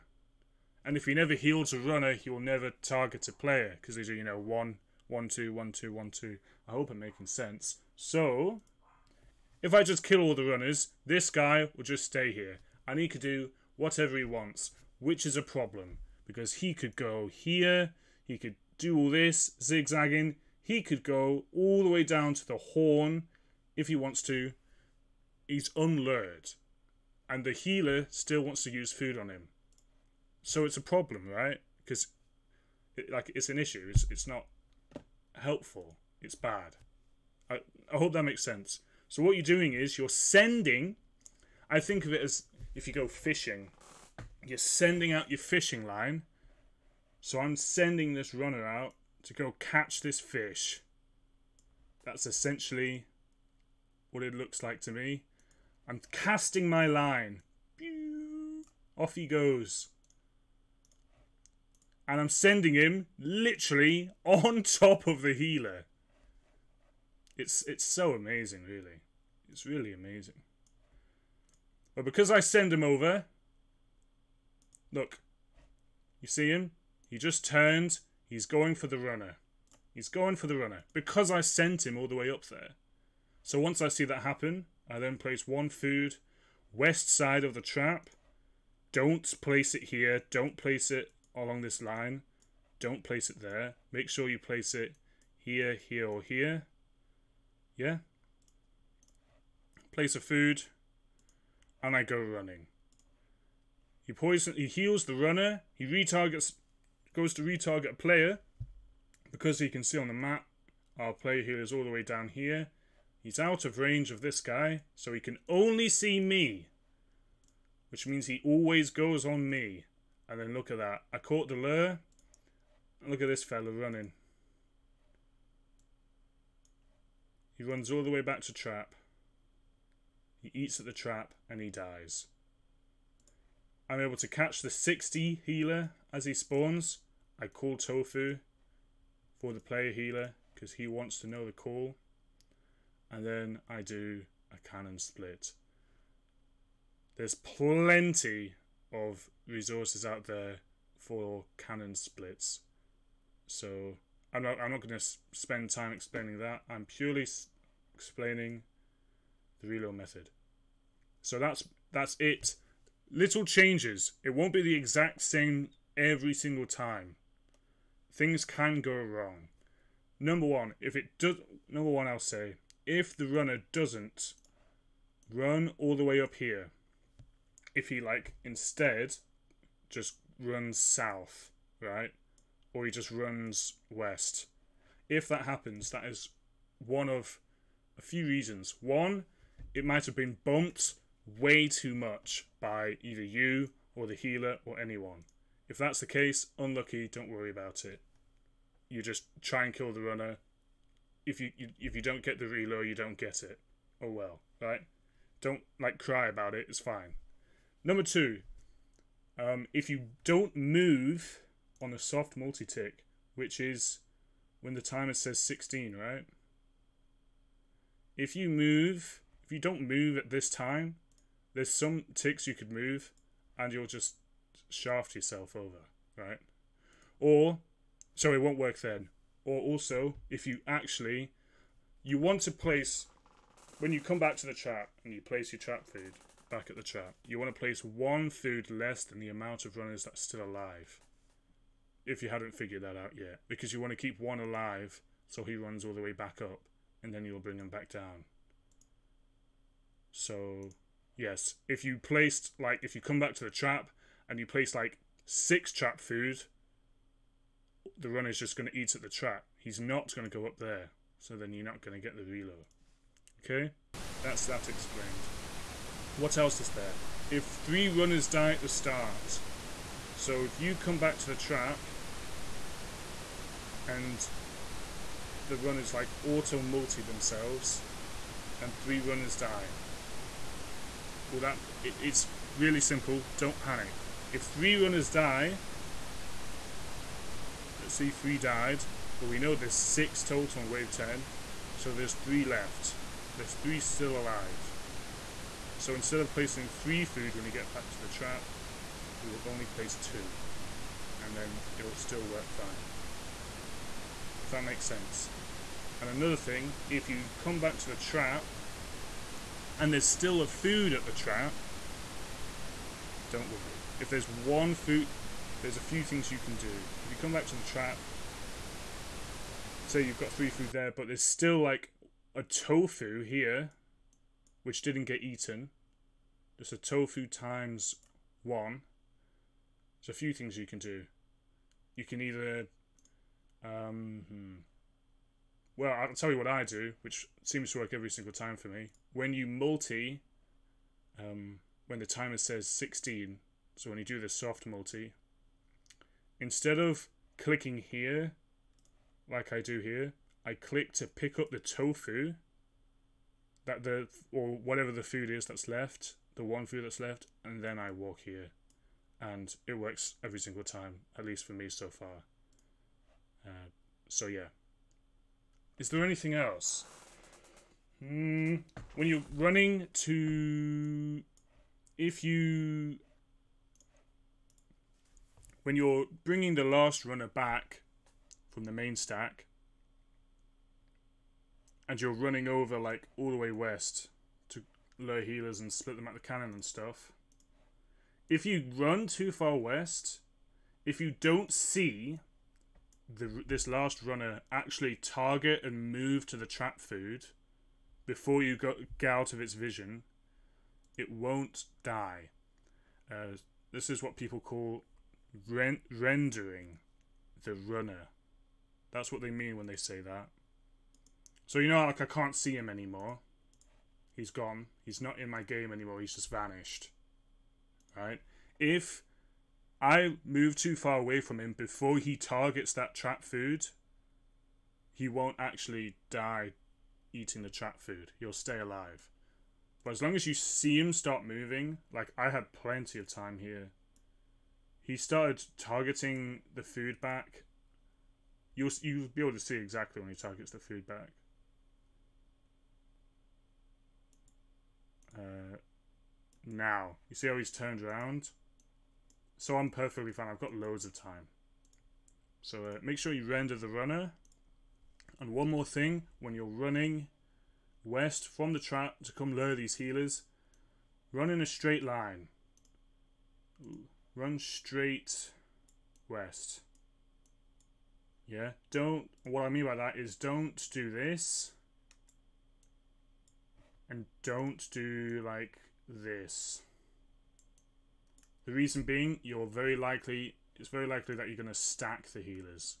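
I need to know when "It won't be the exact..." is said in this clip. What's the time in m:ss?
2:44.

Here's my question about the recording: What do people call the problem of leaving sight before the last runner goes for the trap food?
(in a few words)
Rendering the runner.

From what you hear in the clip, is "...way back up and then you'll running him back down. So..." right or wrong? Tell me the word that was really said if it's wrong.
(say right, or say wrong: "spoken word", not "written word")
wrong: "bring", not "running".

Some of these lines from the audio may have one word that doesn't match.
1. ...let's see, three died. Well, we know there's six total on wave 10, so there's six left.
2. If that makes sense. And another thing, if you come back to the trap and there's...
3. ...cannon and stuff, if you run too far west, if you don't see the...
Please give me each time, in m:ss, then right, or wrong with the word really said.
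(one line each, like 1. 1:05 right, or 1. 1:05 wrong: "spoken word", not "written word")
1. 4:47 wrong: "three", not "six"
2. 5:04 right
3. 6:26 right.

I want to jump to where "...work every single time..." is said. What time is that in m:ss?
5:37.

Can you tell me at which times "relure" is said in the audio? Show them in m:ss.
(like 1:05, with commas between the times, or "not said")
2:39, 3:22, 4:22.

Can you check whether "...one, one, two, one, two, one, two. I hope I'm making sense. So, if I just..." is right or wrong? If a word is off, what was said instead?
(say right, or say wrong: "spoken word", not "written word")
right.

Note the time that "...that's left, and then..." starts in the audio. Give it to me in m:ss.
5:56.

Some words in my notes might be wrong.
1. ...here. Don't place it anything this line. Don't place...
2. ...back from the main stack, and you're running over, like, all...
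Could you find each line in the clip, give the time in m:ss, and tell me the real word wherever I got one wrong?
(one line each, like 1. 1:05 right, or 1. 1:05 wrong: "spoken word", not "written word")
1. 1:29 wrong: "along", not "anything"
2. 6:17 right.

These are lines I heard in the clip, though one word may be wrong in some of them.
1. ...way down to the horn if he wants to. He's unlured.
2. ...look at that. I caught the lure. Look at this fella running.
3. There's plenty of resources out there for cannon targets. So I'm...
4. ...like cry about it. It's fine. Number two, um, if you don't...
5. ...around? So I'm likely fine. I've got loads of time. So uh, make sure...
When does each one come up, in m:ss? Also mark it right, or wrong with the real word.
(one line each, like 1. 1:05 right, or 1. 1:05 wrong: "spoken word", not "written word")
1. 0:21 right
2. 2:00 right
3. 2:27 wrong: "splits", not "targets"
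4. 3:25 right
5. 7:27 wrong: "perfectly", not "likely".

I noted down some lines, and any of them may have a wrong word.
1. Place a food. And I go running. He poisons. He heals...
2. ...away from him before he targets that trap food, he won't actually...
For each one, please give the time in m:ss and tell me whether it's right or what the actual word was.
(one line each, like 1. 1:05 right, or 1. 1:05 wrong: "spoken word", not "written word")
1. 1:39 right
2. 7:00 right.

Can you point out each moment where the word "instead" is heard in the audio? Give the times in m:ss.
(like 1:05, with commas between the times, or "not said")
2:58, 4:55, 5:46.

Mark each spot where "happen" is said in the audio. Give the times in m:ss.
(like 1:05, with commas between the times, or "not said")
1:24, 3:05.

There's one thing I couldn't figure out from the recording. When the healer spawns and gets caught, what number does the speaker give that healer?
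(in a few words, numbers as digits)
60.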